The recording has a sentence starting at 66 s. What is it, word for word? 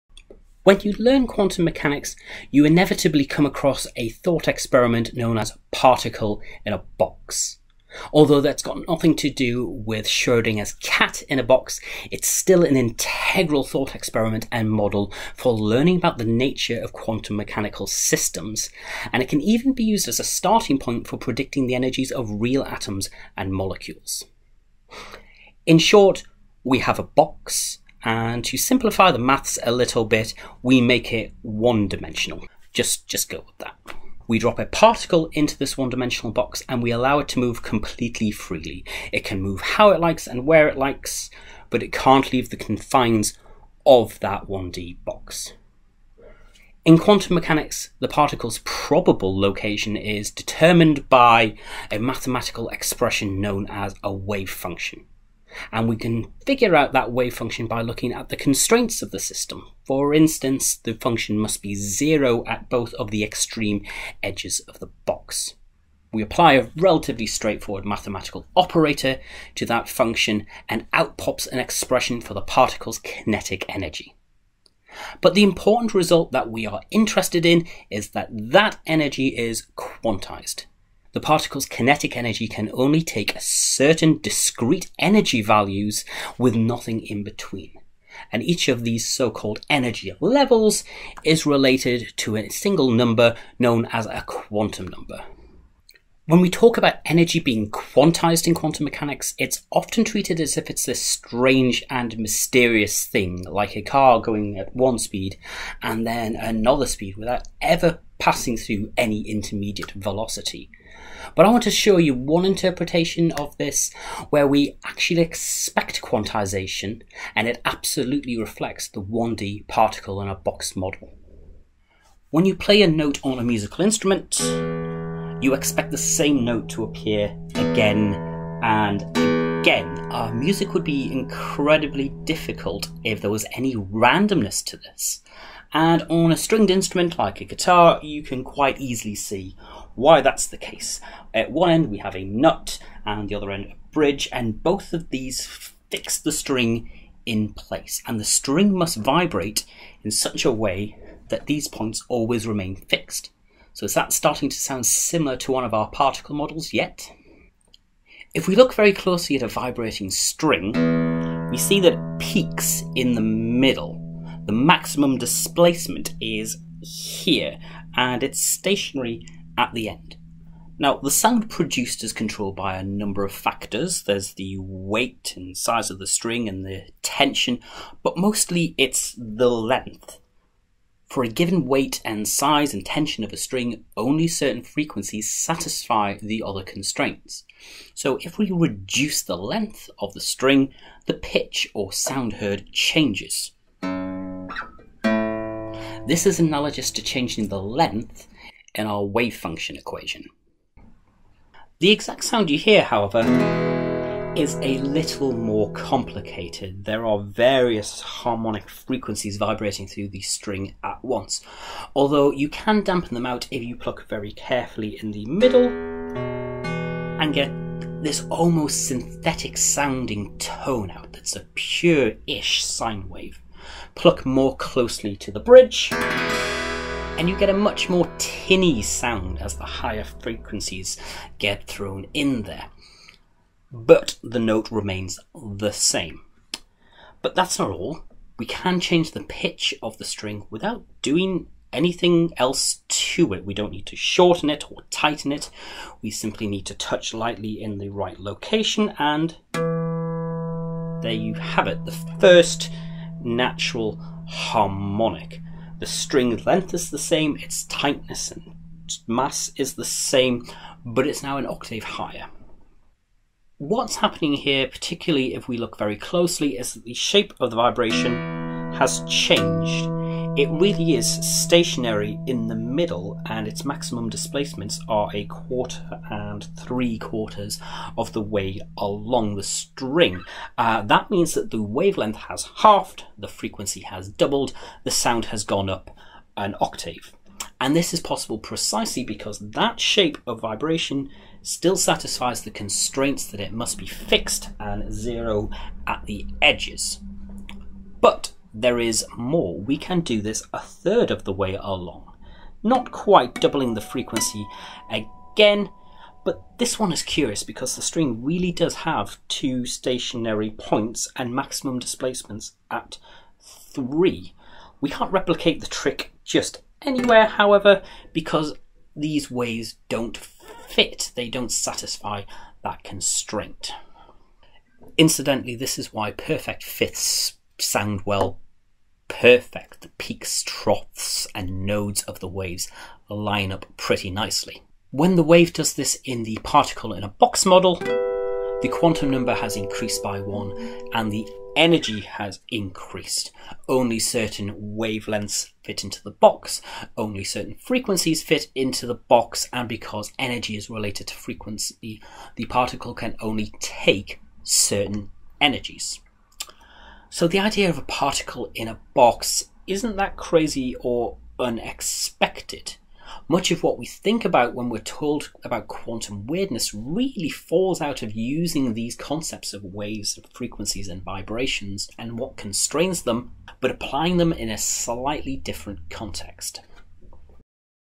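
We apply a relatively straightforward mathematical operator to that function and out pops an expression for the particle's kinetic energy.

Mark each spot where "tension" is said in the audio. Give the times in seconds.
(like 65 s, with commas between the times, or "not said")
177 s, 182 s.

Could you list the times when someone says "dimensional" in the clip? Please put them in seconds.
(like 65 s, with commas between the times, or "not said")
31 s, 35 s.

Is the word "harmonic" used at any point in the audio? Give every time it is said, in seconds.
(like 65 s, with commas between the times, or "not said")
208 s, 254 s.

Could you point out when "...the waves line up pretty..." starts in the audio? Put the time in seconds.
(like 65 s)
332 s.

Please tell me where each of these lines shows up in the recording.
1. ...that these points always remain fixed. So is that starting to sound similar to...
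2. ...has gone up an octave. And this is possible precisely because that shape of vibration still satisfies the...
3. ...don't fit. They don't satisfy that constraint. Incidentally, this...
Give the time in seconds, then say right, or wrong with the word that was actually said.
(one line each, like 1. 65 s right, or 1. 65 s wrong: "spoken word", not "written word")
1. 151 s right
2. 285 s right
3. 319 s right.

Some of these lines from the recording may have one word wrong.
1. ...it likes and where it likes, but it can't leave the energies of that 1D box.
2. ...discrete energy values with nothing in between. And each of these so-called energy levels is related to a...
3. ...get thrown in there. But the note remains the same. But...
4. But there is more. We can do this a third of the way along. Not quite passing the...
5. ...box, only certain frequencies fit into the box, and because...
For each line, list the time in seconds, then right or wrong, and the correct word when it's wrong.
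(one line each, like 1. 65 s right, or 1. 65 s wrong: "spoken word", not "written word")
1. 39 s wrong: "confines", not "energies"
2. 84 s right
3. 231 s right
4. 297 s wrong: "doubling", not "passing"
5. 346 s right.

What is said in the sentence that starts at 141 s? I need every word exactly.
At one end we have a nut and the other end a bridge, and both of these fix the string in place.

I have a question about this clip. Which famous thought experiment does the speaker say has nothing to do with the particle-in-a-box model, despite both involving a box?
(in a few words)
Schrodinger's cat.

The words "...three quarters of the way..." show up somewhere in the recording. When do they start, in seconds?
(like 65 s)
276 s.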